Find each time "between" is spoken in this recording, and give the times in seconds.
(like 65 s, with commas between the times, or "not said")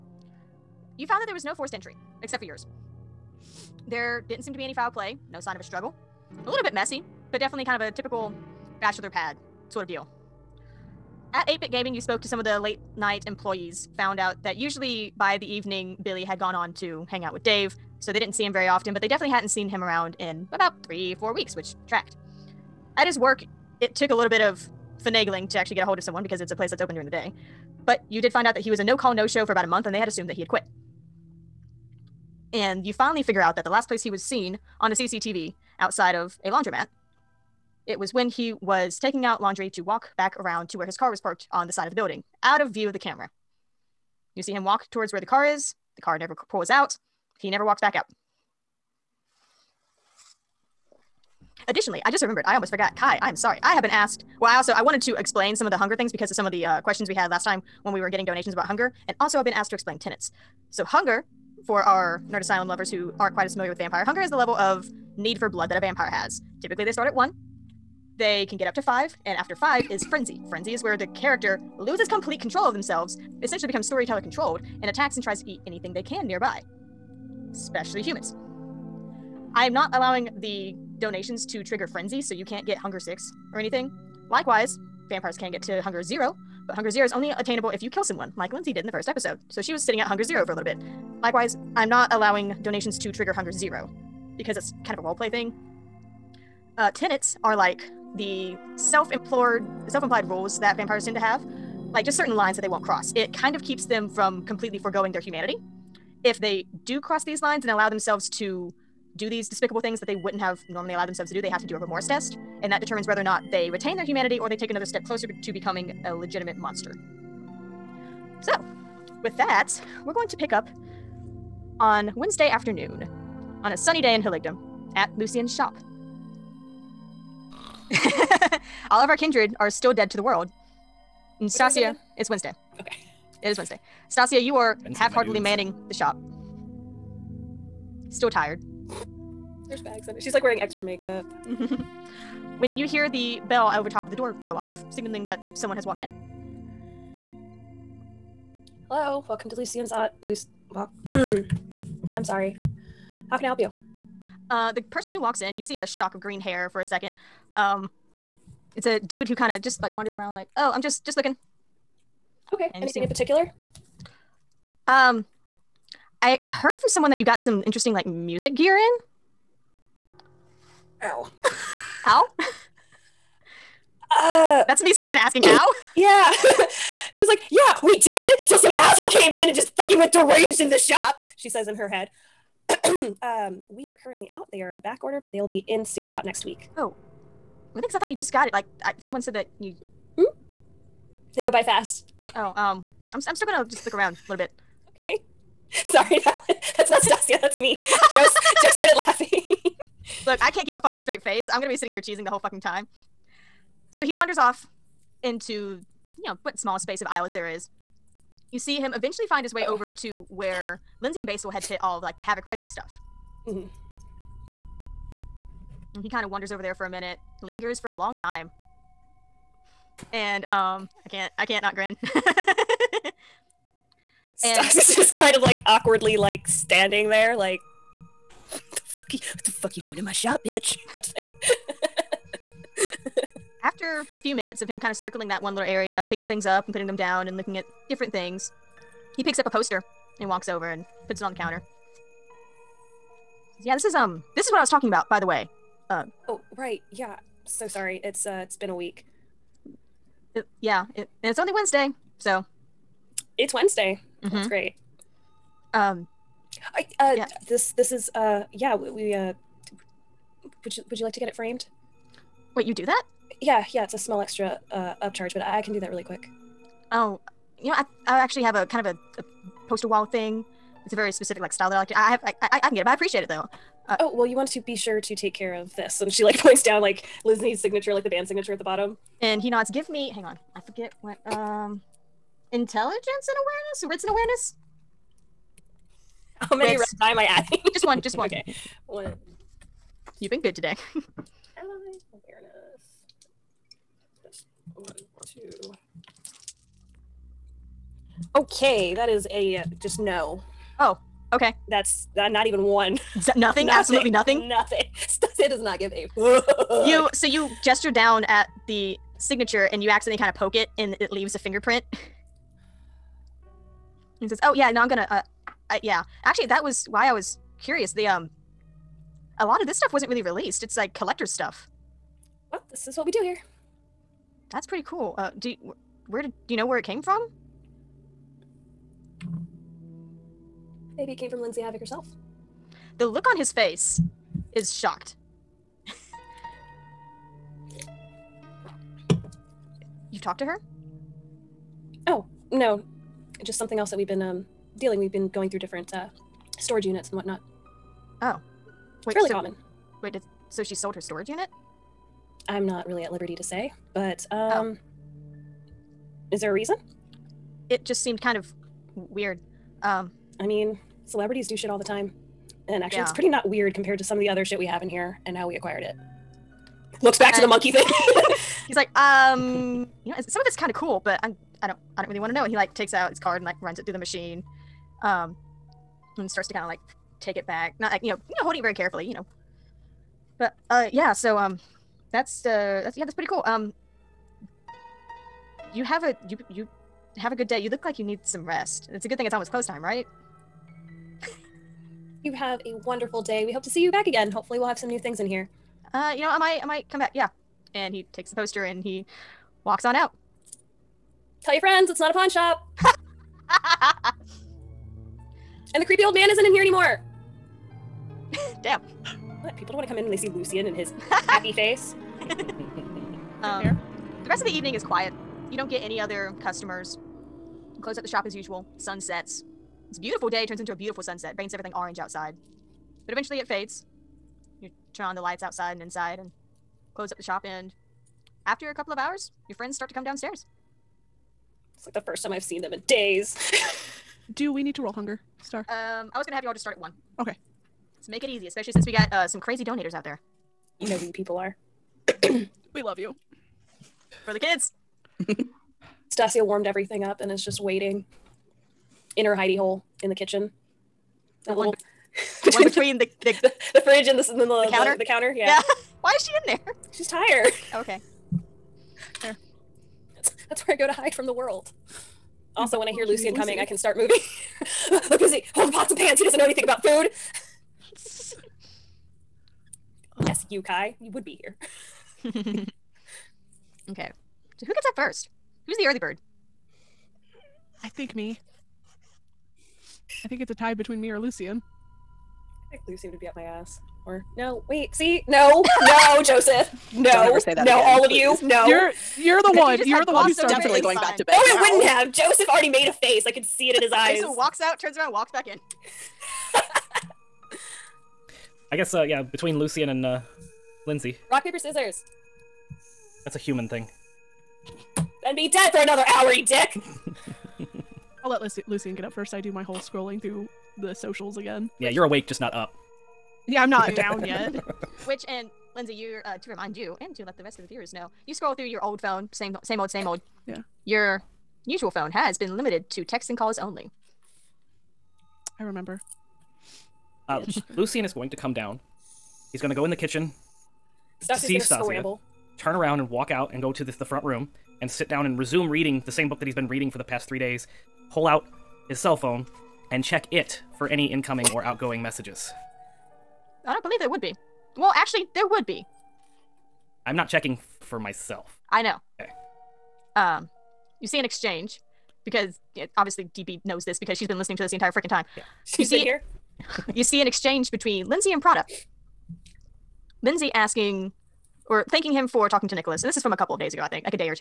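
452 s, 480 s, 499 s, 557 s.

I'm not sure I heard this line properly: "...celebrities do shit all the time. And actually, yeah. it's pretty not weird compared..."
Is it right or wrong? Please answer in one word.
right.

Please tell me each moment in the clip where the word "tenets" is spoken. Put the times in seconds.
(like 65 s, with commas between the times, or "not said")
59 s, 96 s.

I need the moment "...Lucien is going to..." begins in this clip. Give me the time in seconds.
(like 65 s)
527 s.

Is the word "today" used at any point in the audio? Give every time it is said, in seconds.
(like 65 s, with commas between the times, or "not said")
290 s.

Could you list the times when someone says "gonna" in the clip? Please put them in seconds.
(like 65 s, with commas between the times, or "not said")
193 s, 201 s, 314 s, 436 s.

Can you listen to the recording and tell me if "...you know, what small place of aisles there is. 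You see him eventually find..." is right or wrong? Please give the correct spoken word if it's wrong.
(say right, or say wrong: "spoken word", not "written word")
wrong: "space", not "place".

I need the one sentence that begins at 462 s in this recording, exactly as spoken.
Also, when I hear oh, Lucien coming, I can start moving.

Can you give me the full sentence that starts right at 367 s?
Looks back and to the monkey thing.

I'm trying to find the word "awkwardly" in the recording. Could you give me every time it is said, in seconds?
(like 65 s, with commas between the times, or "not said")
225 s.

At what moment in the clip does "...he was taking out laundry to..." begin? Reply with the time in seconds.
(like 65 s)
38 s.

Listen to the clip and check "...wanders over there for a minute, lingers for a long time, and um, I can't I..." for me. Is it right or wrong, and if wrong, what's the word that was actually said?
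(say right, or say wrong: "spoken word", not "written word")
right.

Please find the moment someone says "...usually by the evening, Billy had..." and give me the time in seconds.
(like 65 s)
14 s.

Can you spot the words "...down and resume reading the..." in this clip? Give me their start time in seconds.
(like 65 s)
535 s.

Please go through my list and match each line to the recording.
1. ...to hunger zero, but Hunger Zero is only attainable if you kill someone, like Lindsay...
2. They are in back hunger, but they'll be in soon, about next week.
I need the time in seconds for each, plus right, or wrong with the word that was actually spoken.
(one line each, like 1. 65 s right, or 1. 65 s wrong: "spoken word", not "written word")
1. 85 s right
2. 184 s wrong: "order", not "hunger".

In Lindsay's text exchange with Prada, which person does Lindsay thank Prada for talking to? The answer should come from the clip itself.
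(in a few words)
Nicholas.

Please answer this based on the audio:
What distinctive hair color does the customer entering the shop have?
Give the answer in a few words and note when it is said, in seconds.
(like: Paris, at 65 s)
Green, at 156 s.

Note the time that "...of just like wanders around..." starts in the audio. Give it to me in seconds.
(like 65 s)
159 s.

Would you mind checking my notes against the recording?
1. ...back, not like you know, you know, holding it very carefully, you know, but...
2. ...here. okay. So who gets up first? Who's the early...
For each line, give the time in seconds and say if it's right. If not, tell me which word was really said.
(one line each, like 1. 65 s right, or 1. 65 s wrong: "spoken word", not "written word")
1. 377 s right
2. 471 s right.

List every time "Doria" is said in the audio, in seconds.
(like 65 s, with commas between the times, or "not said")
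not said.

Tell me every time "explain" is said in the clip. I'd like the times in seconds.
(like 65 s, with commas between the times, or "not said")
55 s, 59 s.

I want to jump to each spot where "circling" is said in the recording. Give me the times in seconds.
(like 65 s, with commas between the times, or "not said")
234 s.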